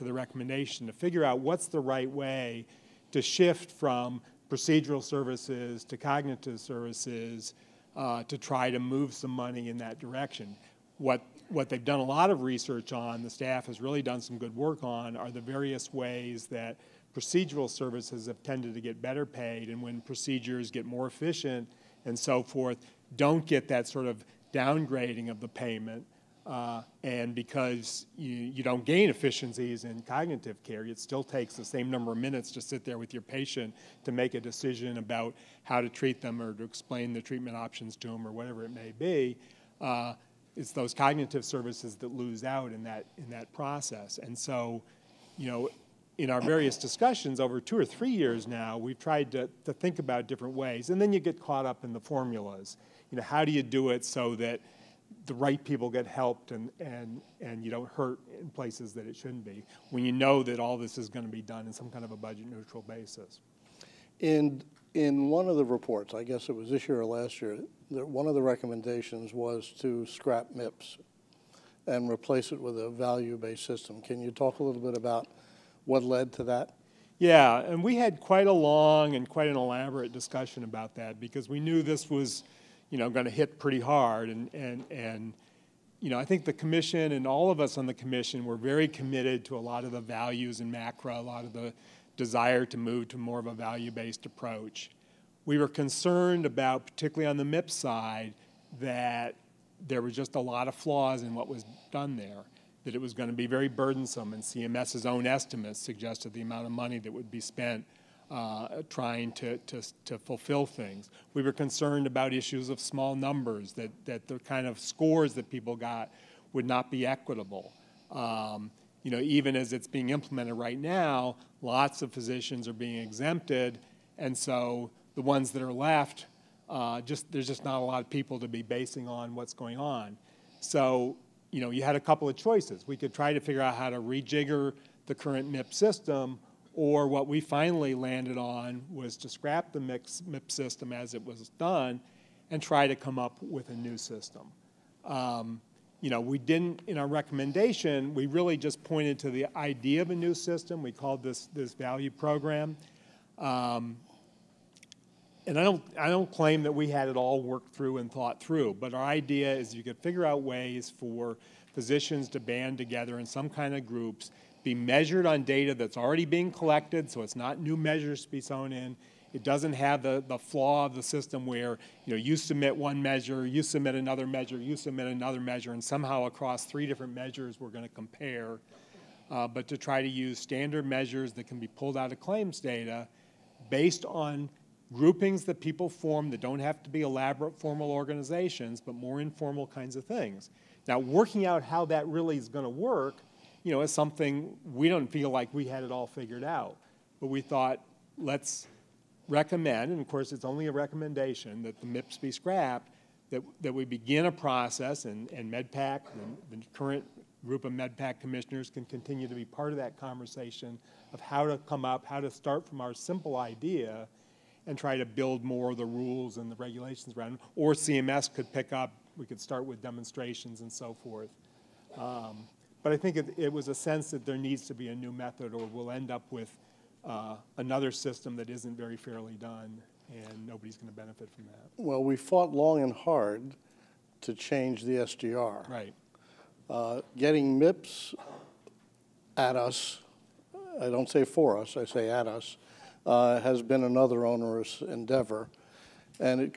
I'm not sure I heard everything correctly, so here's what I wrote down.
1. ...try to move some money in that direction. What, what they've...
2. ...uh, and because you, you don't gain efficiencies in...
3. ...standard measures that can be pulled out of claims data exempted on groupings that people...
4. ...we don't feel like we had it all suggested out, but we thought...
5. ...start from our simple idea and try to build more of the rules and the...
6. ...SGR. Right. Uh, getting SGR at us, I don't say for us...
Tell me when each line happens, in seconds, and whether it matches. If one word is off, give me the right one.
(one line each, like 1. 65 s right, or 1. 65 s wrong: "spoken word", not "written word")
1. 8 s right
2. 26 s right
3. 180 s wrong: "based", not "exempted"
4. 194 s wrong: "figured", not "suggested"
5. 212 s right
6. 234 s wrong: "MIPS", not "SGR".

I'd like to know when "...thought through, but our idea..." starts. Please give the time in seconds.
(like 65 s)
158 s.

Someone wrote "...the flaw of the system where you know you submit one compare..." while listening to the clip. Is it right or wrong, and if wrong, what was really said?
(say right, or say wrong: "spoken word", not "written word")
wrong: "measure", not "compare".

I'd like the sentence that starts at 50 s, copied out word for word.
And then you get caught up in the formulas.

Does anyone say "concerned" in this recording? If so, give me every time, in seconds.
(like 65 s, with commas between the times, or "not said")
95 s, 111 s.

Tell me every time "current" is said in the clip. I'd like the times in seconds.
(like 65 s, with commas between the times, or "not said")
135 s, 206 s.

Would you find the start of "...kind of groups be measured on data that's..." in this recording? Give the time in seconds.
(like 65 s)
163 s.